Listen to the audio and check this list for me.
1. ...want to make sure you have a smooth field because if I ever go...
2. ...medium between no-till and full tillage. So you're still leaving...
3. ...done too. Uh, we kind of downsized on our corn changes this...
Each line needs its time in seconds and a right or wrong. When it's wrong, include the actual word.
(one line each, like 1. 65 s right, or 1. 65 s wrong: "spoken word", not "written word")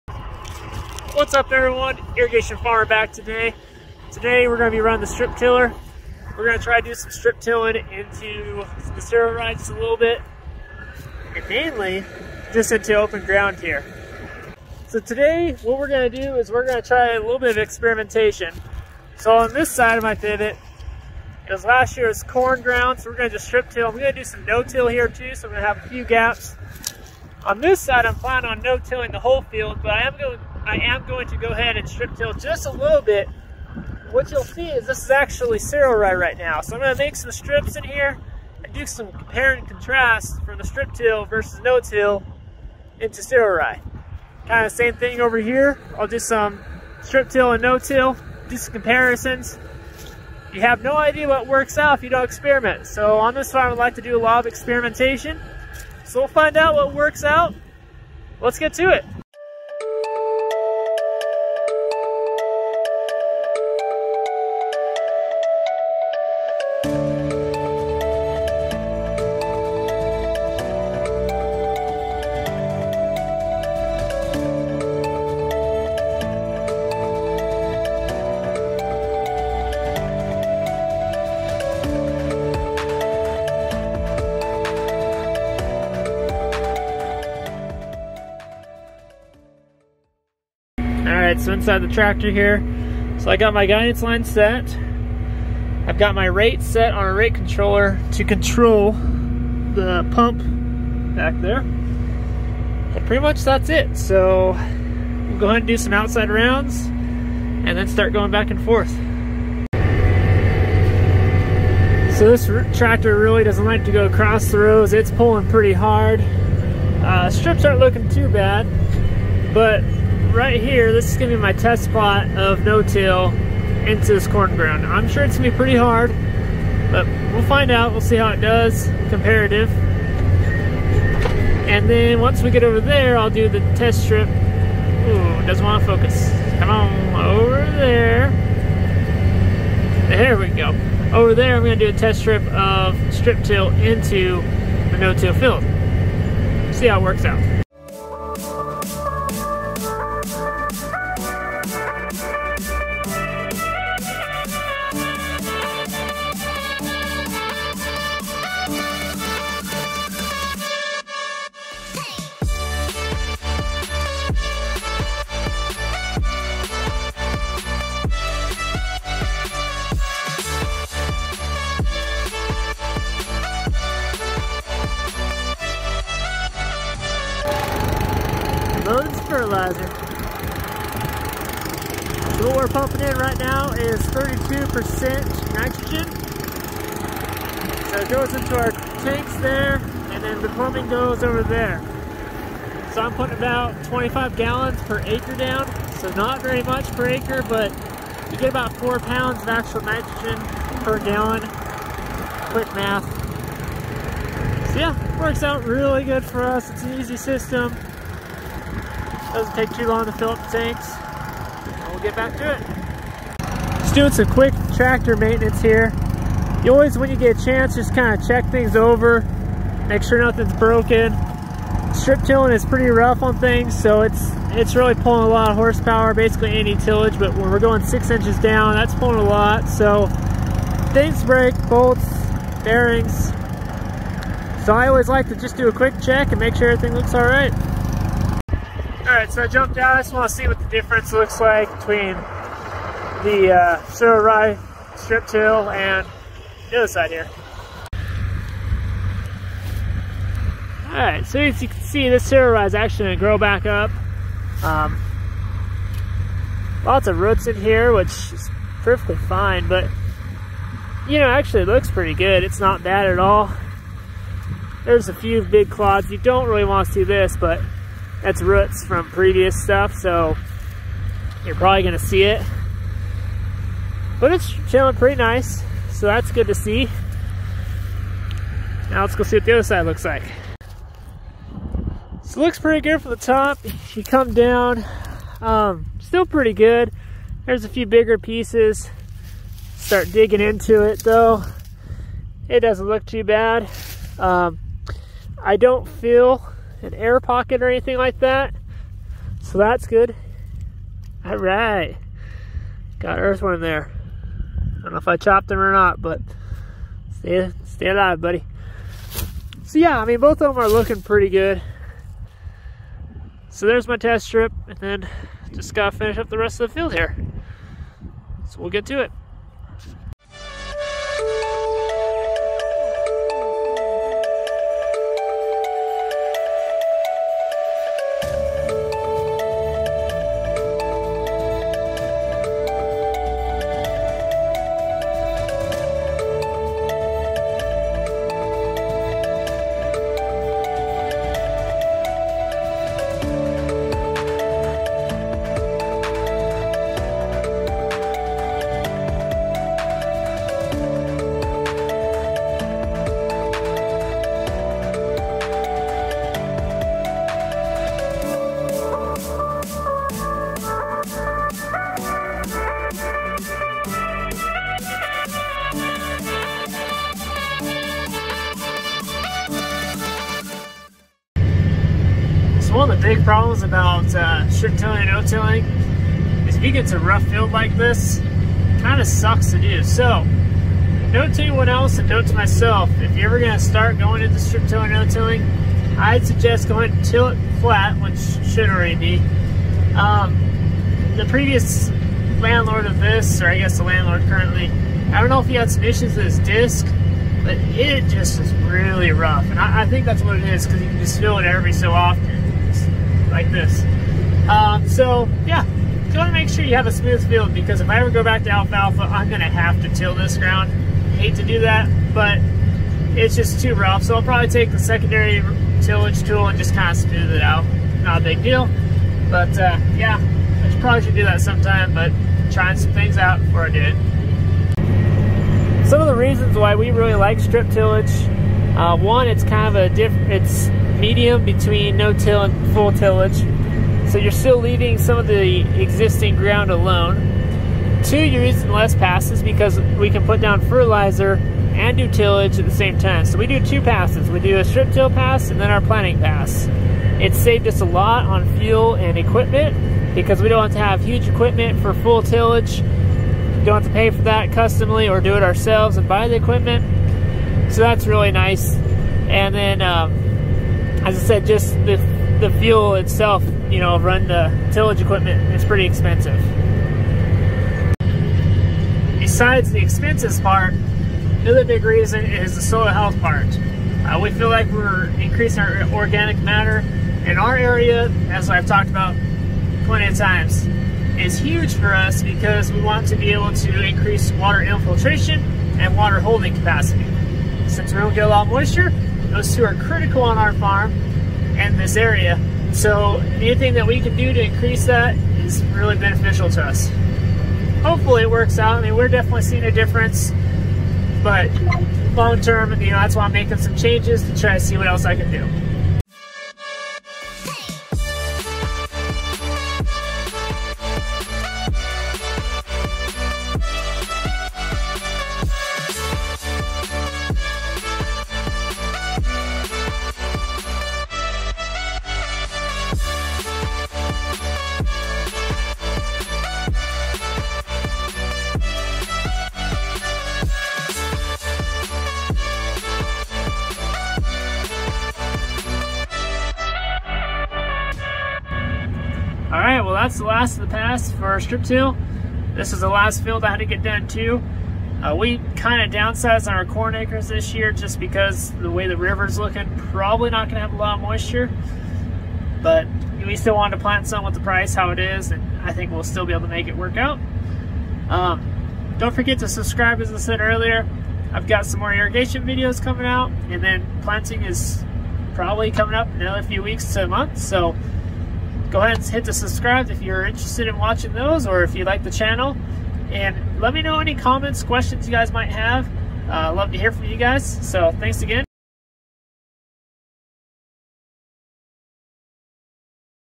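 1. 406 s right
2. 431 s right
3. 543 s wrong: "acres", not "changes".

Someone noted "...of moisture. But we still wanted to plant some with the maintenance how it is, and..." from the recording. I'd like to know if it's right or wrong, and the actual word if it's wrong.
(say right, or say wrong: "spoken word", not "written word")
wrong: "price", not "maintenance".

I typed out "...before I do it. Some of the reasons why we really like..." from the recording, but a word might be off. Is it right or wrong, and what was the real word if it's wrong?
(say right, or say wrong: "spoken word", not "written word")
right.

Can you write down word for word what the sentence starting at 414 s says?
So I'll probably take the secondary tillage tool and just kind of smooth it out.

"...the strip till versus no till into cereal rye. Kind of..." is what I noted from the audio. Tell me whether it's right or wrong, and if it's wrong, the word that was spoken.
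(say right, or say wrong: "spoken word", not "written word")
right.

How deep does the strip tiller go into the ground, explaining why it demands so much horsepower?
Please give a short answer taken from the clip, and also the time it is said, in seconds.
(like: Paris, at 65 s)
6 inches, at 227 s.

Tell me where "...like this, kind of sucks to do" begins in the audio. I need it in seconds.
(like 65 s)
377 s.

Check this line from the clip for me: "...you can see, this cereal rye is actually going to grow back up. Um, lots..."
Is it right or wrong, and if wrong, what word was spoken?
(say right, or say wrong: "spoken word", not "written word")
right.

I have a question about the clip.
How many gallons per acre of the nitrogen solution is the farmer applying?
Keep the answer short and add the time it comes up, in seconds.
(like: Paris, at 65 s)
25, at 193 s.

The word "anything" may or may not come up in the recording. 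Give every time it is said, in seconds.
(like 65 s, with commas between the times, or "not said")
297 s, 493 s.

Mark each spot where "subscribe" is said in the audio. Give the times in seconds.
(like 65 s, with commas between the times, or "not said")
559 s, 569 s.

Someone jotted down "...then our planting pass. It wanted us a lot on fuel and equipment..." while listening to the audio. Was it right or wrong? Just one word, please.
wrong.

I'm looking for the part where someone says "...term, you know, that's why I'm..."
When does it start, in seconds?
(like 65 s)
502 s.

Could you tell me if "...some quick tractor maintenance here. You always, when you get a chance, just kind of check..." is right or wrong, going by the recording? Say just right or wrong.
right.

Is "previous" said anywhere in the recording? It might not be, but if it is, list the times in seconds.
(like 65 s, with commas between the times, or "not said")
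269 s, 391 s.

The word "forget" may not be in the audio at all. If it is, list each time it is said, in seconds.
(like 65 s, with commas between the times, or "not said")
559 s.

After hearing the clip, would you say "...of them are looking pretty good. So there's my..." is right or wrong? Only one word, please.
right.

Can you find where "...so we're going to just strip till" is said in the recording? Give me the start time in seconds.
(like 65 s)
23 s.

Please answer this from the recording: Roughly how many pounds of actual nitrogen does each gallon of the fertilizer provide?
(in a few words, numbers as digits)
4.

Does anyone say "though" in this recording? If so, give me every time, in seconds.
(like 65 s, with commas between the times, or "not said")
290 s.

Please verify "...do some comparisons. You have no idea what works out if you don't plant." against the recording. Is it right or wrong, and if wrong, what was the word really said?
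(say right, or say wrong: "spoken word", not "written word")
wrong: "experiment", not "plant".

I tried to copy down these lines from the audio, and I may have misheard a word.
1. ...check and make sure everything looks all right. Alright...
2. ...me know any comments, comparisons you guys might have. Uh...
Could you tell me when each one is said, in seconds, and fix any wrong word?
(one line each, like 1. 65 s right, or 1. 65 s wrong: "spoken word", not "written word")
1. 236 s right
2. 573 s wrong: "questions", not "comparisons".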